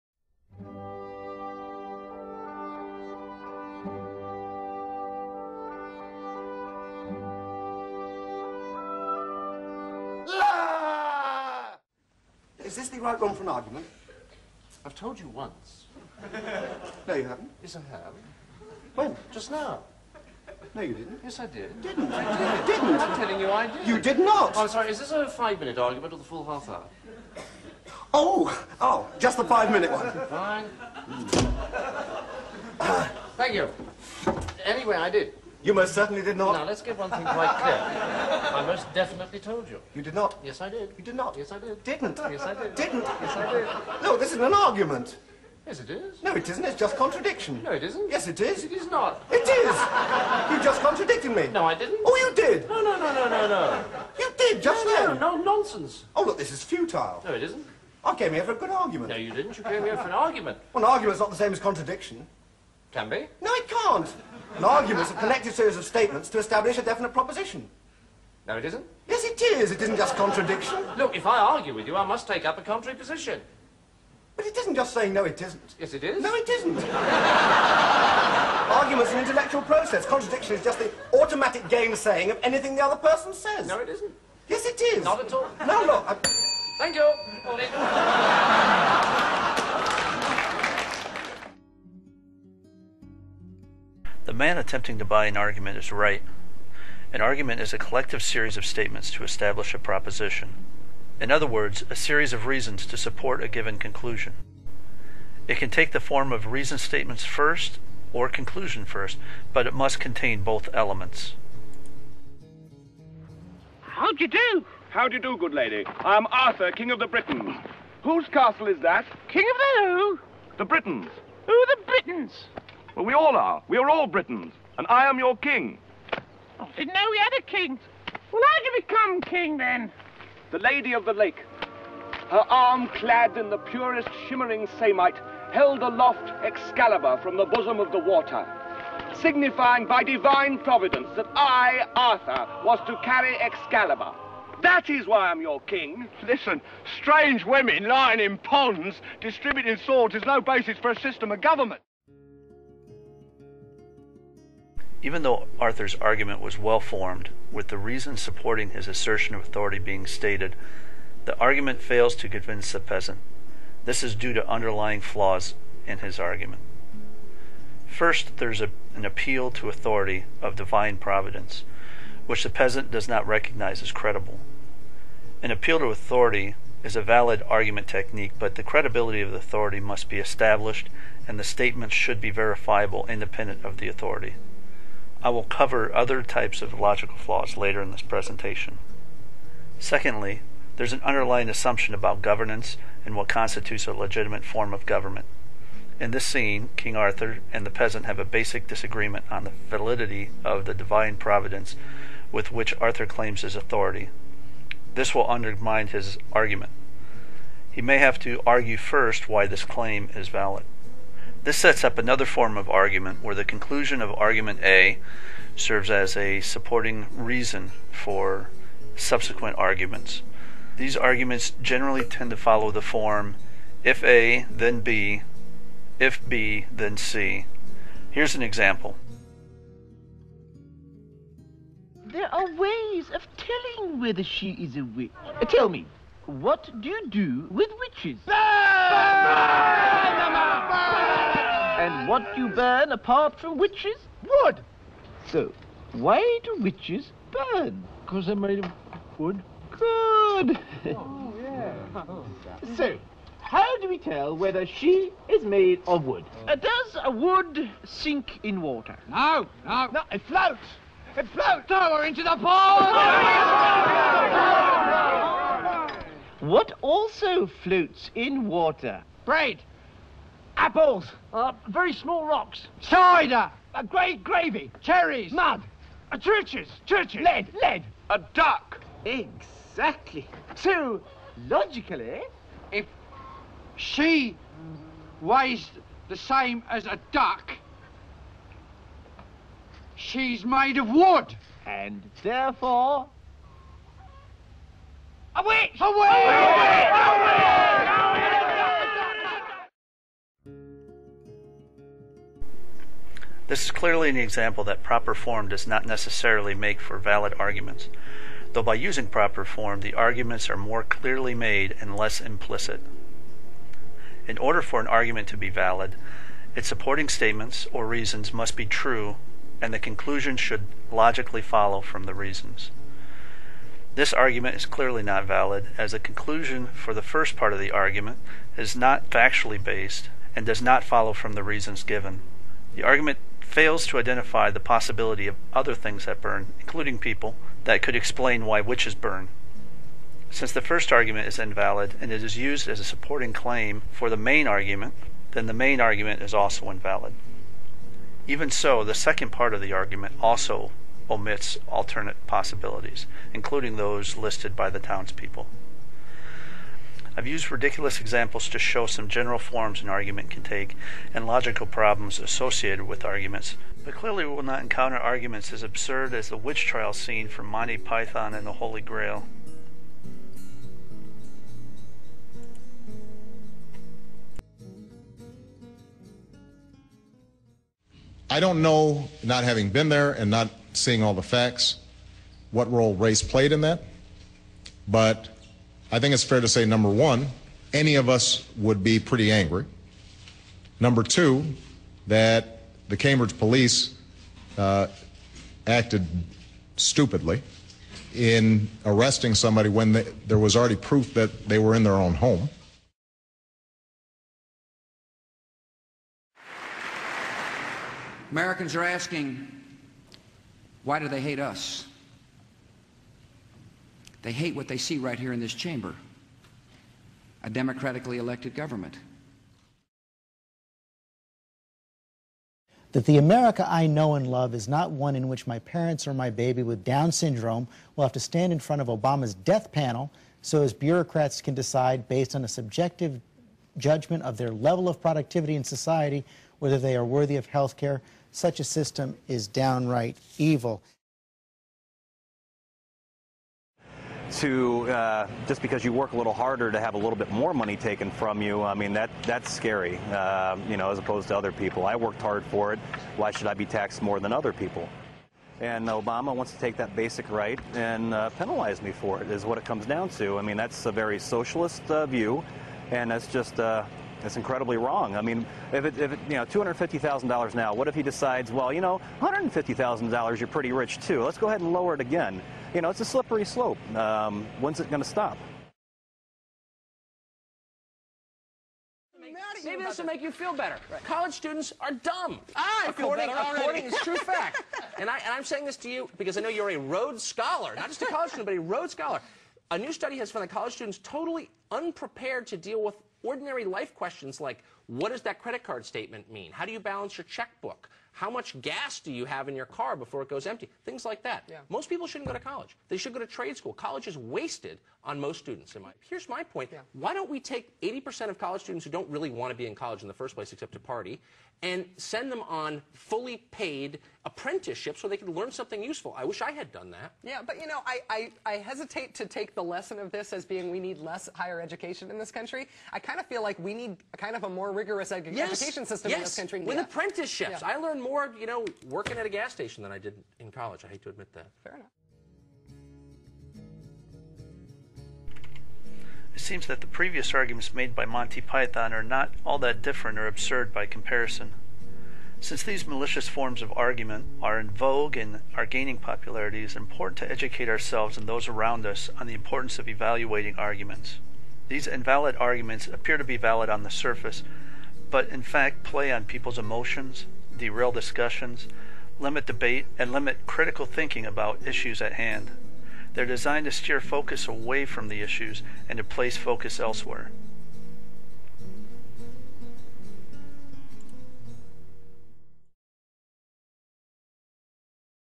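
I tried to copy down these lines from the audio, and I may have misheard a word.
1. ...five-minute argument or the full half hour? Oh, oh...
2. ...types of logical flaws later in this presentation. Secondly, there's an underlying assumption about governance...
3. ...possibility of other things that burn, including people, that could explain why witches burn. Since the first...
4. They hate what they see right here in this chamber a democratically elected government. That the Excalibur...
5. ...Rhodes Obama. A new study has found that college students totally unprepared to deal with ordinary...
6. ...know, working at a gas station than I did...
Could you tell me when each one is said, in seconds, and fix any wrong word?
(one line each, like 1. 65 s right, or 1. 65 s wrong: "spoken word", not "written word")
1. 25 s right
2. 186 s right
3. 334 s right
4. 414 s wrong: "America", not "Excalibur"
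5. 488 s wrong: "Scholar", not "Obama"
6. 528 s right.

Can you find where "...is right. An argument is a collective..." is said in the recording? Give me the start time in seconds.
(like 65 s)
95 s.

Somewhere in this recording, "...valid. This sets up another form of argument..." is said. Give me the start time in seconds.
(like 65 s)
210 s.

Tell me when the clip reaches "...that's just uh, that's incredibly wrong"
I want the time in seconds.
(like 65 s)
463 s.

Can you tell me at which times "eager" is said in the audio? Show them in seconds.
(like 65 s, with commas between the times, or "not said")
not said.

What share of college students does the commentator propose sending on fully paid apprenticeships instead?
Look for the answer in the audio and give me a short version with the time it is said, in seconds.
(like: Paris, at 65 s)
80%, at 507 s.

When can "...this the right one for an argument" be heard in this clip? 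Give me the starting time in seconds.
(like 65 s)
12 s.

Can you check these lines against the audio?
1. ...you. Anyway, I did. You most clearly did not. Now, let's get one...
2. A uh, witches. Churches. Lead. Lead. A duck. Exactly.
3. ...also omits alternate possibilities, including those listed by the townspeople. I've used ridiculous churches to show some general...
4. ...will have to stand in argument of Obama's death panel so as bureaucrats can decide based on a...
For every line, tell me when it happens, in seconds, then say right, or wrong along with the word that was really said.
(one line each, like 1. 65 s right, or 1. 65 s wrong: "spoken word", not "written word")
1. 33 s wrong: "certainly", not "clearly"
2. 276 s wrong: "churches", not "witches"
3. 350 s wrong: "examples", not "churches"
4. 427 s wrong: "front", not "argument".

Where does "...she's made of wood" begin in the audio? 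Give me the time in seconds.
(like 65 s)
289 s.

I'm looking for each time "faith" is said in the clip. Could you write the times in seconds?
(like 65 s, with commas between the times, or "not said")
not said.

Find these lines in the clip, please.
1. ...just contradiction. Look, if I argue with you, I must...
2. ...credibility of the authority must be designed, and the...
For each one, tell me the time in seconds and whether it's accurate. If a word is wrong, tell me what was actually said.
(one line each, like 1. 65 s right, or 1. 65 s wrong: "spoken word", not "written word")
1. 69 s right
2. 178 s wrong: "established", not "designed".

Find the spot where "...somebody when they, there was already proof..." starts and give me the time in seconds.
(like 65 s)
399 s.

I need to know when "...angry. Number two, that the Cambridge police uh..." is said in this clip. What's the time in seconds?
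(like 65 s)
389 s.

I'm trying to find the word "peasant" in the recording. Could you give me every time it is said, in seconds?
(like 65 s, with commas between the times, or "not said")
162 s, 172 s, 197 s.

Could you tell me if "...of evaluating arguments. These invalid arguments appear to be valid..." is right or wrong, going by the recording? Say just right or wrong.
right.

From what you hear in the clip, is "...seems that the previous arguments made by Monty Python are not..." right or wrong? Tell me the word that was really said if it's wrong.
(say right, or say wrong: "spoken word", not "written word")
right.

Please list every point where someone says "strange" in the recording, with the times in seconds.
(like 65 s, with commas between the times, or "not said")
146 s.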